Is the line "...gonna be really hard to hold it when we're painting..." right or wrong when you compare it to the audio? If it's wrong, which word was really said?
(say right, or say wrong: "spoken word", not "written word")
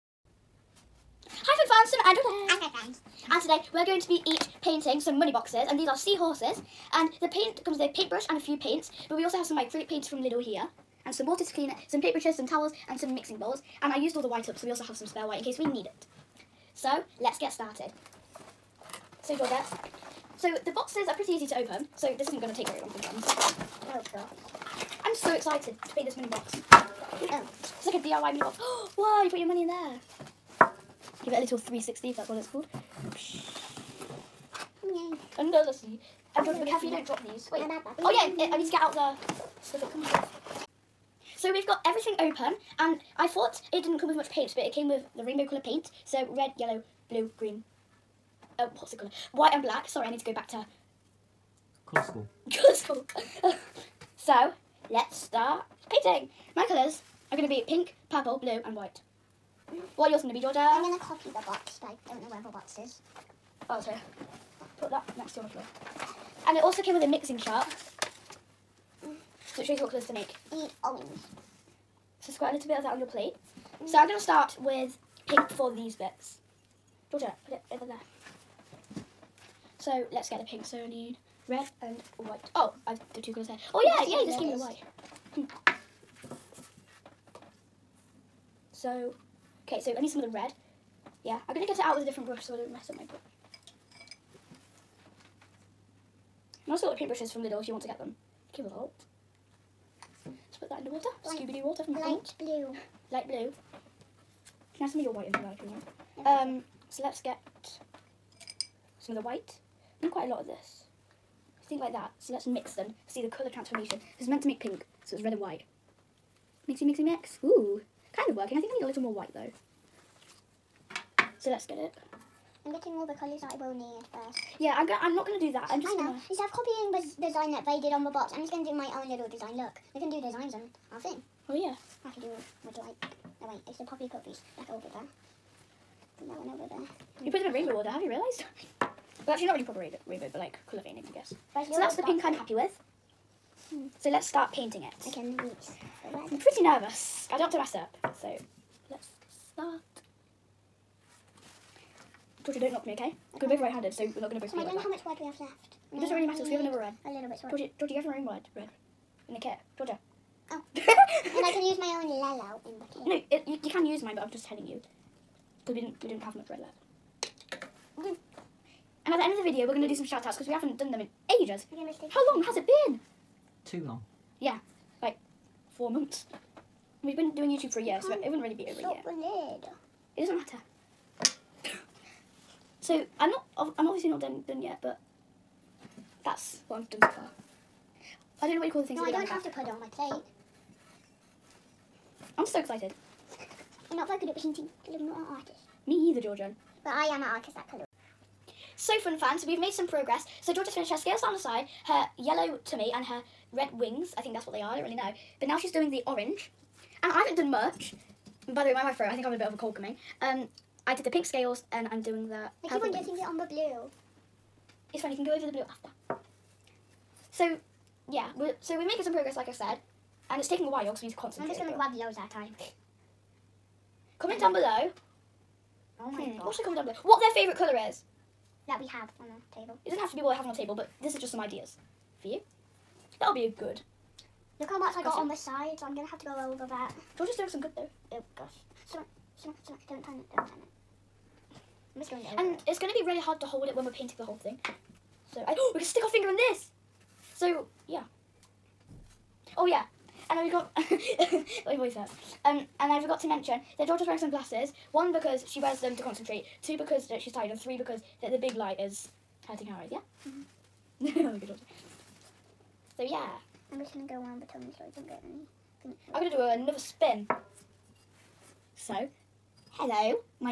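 right.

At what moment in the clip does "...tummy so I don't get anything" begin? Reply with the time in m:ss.
4:24.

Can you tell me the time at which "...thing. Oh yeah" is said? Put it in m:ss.
2:10.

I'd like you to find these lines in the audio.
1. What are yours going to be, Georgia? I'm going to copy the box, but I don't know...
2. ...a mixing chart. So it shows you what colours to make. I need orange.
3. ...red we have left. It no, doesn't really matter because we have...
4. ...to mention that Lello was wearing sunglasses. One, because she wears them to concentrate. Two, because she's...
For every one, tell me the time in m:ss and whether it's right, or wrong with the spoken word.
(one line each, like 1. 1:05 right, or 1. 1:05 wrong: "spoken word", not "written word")
1. 0:59 right
2. 1:07 right
3. 2:35 right
4. 4:13 wrong: "George", not "Lello".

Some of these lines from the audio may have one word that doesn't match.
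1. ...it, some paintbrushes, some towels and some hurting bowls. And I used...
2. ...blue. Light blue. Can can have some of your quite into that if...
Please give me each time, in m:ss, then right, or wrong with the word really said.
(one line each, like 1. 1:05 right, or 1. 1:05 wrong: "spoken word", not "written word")
1. 0:11 wrong: "mixing", not "hurting"
2. 1:42 wrong: "white", not "quite".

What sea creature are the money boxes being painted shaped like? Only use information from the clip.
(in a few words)
Seahorses.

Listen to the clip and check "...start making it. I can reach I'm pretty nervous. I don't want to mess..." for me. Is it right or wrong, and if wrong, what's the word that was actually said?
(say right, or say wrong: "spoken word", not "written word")
wrong: "painting", not "making".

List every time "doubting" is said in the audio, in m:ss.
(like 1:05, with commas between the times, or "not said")
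not said.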